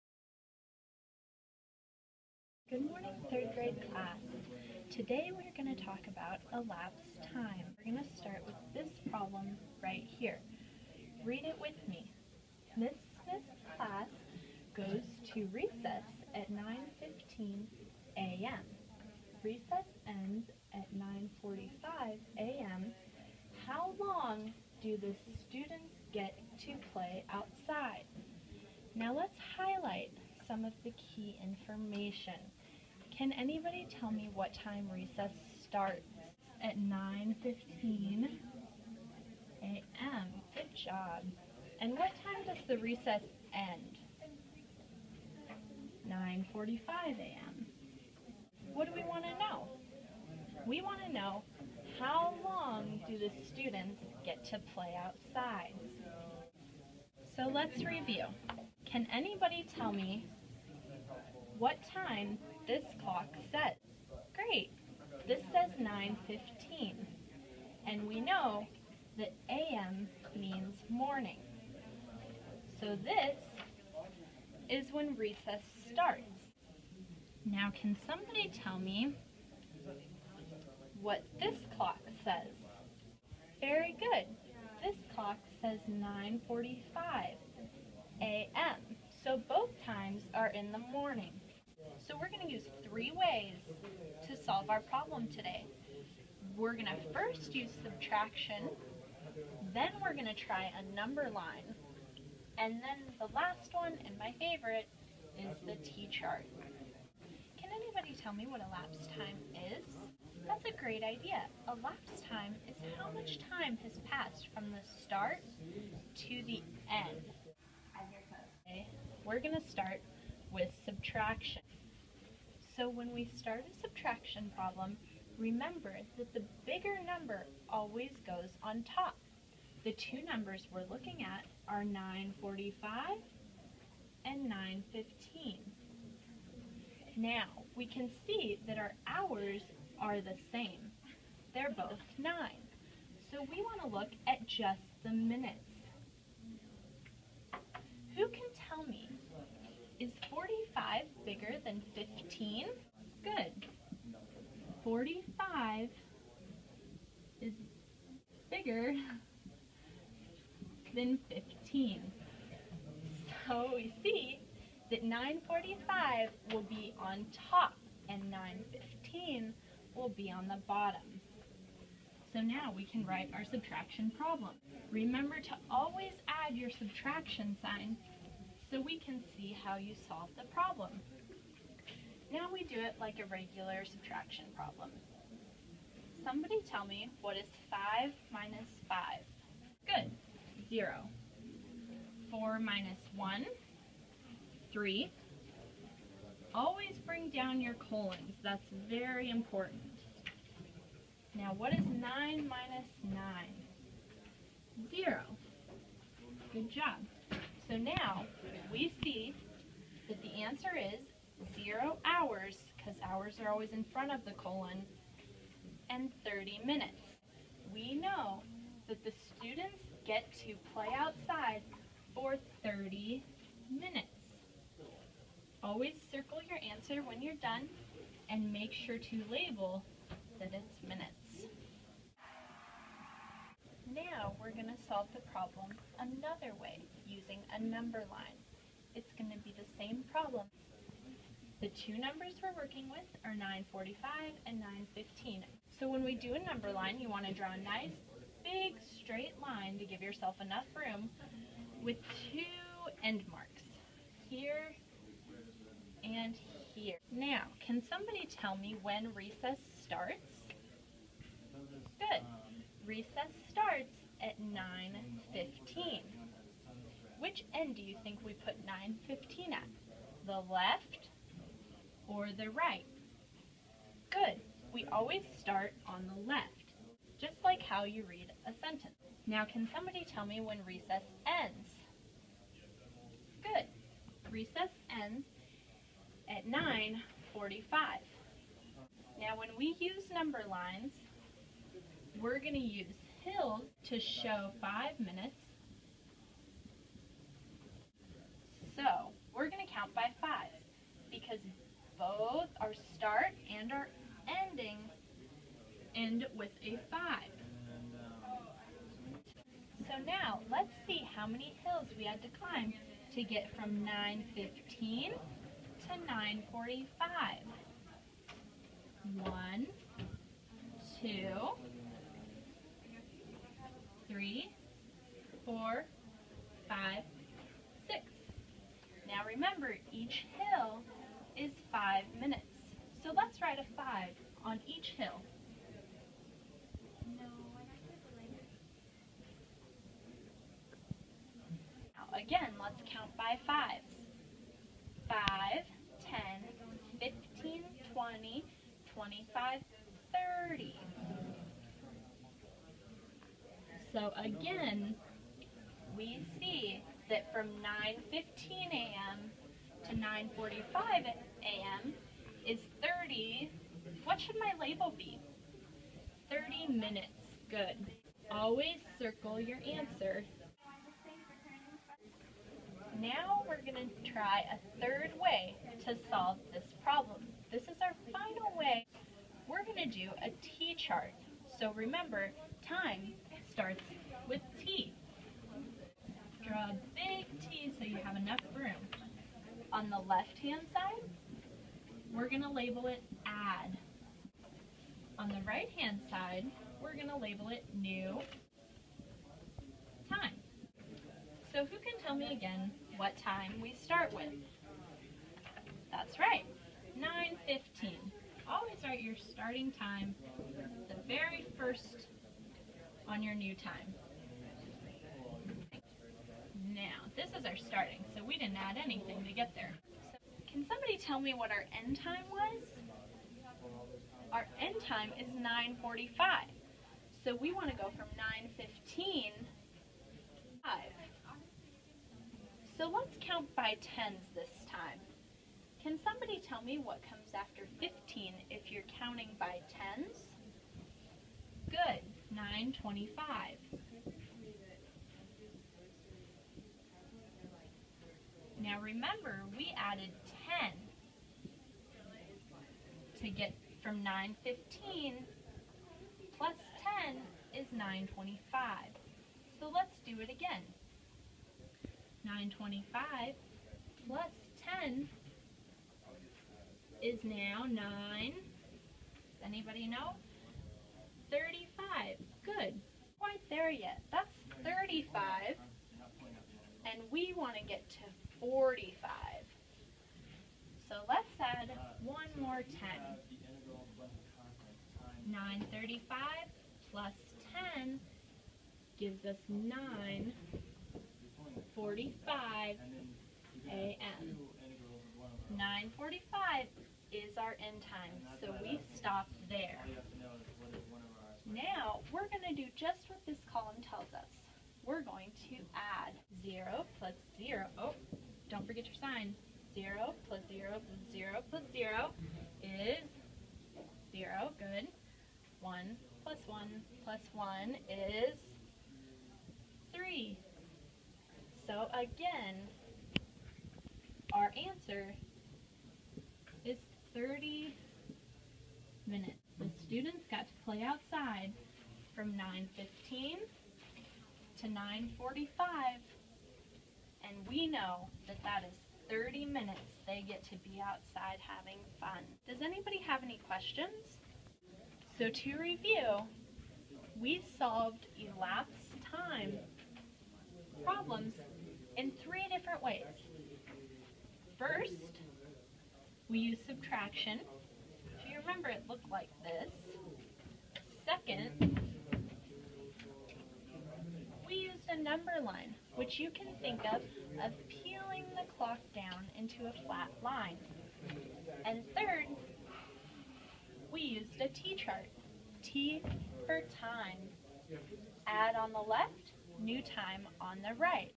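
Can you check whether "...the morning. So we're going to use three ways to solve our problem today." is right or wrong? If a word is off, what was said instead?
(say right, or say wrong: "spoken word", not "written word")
right.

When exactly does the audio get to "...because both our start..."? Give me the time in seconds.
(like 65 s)
301 s.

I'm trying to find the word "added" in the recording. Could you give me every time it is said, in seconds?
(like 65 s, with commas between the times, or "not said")
449 s.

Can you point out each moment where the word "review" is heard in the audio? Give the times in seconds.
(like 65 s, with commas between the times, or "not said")
57 s, 545 s.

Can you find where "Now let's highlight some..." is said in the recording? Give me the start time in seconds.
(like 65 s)
28 s.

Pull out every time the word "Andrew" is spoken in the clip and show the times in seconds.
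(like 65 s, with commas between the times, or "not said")
not said.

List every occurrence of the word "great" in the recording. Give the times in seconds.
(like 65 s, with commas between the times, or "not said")
64 s, 110 s.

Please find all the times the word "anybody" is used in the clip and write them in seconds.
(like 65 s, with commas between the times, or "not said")
33 s, 59 s, 107 s, 469 s, 542 s.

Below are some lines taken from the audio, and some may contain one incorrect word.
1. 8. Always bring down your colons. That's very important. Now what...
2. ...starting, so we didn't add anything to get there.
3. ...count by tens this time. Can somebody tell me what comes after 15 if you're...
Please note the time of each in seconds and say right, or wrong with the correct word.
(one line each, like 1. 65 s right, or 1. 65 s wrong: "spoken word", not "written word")
1. 194 s wrong: "3", not "8"
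2. 417 s right
3. 433 s right.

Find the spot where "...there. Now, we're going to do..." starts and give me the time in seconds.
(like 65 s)
499 s.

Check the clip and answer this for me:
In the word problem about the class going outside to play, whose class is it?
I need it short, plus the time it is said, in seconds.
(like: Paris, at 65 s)
Miss Smith's, at 12 s.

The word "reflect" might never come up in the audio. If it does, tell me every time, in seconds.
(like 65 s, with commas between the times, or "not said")
not said.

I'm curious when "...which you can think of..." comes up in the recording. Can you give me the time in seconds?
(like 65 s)
565 s.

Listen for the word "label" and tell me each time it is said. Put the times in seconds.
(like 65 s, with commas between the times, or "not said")
229 s, 364 s, 392 s, 397 s.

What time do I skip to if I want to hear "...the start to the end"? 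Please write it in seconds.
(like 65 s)
114 s.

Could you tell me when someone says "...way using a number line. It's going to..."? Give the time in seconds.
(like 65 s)
236 s.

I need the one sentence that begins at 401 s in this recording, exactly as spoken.
So who can tell me again what time we start with?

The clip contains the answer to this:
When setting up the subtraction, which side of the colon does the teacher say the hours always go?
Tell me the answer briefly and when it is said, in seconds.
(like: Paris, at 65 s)
in front, at 213 s.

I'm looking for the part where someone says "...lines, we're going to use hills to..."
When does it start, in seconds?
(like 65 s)
290 s.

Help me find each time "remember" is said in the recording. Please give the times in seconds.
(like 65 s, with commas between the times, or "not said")
125 s, 174 s, 381 s, 448 s, 558 s.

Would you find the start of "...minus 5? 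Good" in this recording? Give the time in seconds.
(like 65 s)
188 s.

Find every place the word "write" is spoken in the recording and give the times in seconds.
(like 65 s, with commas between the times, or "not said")
173 s, 408 s.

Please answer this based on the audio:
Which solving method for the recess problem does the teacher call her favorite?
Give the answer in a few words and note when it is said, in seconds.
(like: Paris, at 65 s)
T-chart, at 105 s.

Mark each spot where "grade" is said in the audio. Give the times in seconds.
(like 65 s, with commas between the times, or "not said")
3 s.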